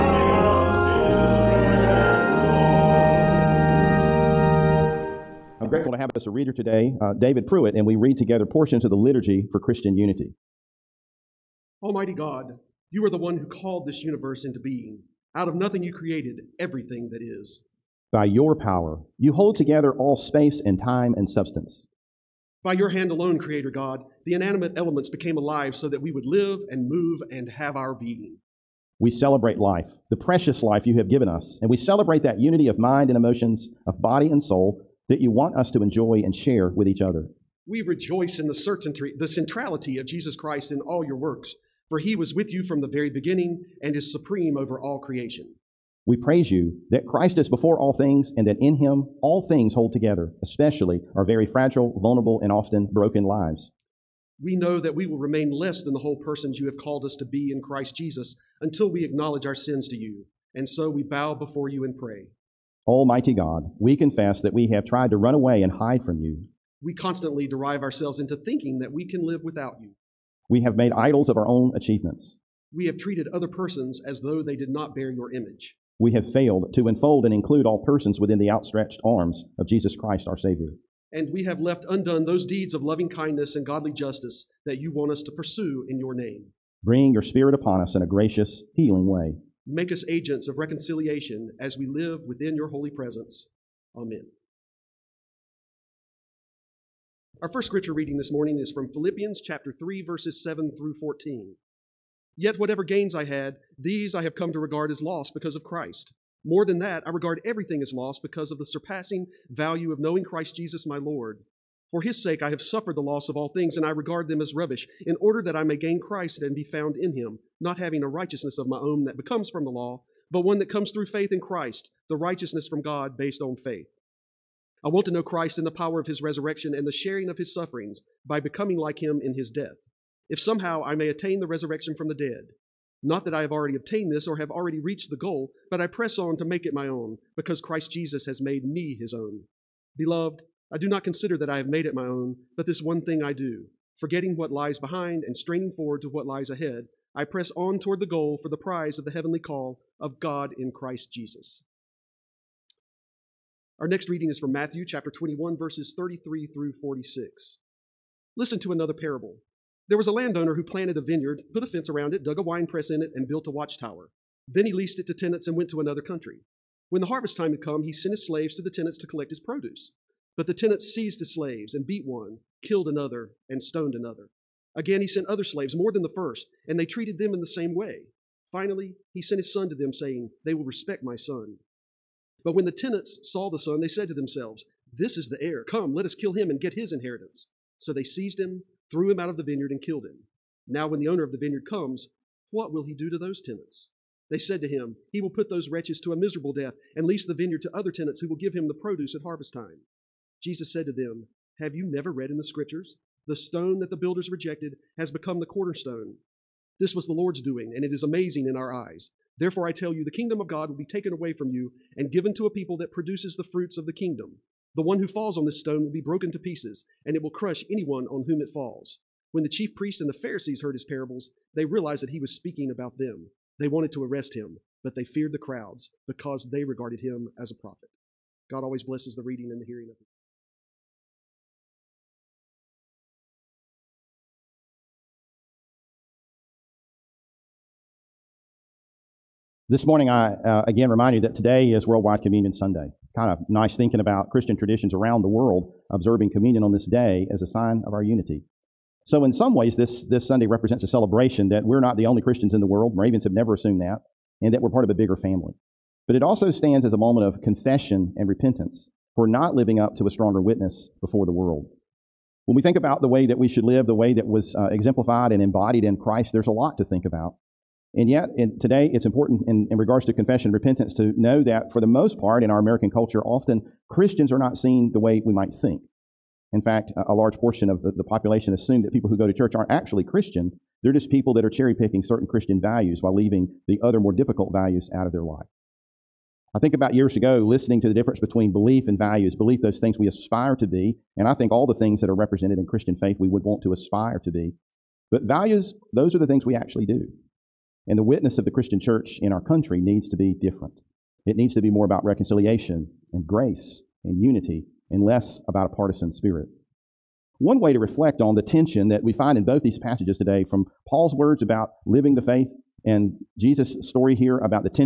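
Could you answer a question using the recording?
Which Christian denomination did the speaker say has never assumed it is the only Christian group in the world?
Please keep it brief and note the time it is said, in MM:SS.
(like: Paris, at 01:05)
Moravians, at 04:12.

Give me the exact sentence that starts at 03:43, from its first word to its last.
They wanted to arrest him, but they feared the crowds because they regarded him as a prophet.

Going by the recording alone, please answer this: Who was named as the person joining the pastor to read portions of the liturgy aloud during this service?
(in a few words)
David Pruitt.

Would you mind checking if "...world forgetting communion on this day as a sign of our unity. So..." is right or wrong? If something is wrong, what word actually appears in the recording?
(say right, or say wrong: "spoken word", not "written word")
wrong: "observing", not "forgetting".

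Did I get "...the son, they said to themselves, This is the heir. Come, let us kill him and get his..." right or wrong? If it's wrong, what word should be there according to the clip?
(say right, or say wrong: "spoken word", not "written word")
right.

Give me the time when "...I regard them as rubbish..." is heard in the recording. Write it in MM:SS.
01:53.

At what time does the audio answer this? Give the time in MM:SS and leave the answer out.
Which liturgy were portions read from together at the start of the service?
00:08.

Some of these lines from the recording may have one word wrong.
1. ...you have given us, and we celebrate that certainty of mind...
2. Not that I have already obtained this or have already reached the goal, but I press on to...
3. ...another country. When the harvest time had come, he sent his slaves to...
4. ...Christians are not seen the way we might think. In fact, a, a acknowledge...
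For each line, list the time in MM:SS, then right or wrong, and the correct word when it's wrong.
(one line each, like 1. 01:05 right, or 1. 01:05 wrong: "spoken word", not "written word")
1. 00:30 wrong: "unity", not "certainty"
2. 02:13 right
3. 02:45 right
4. 04:33 wrong: "large", not "acknowledge".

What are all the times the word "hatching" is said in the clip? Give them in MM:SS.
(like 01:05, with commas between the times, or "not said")
not said.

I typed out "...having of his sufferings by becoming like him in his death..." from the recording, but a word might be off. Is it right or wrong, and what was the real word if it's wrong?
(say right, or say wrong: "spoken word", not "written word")
wrong: "sharing", not "having".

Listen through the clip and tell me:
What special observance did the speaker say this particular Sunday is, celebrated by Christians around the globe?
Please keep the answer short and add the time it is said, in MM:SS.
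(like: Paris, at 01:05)
Worldwide Communion Sunday, at 04:01.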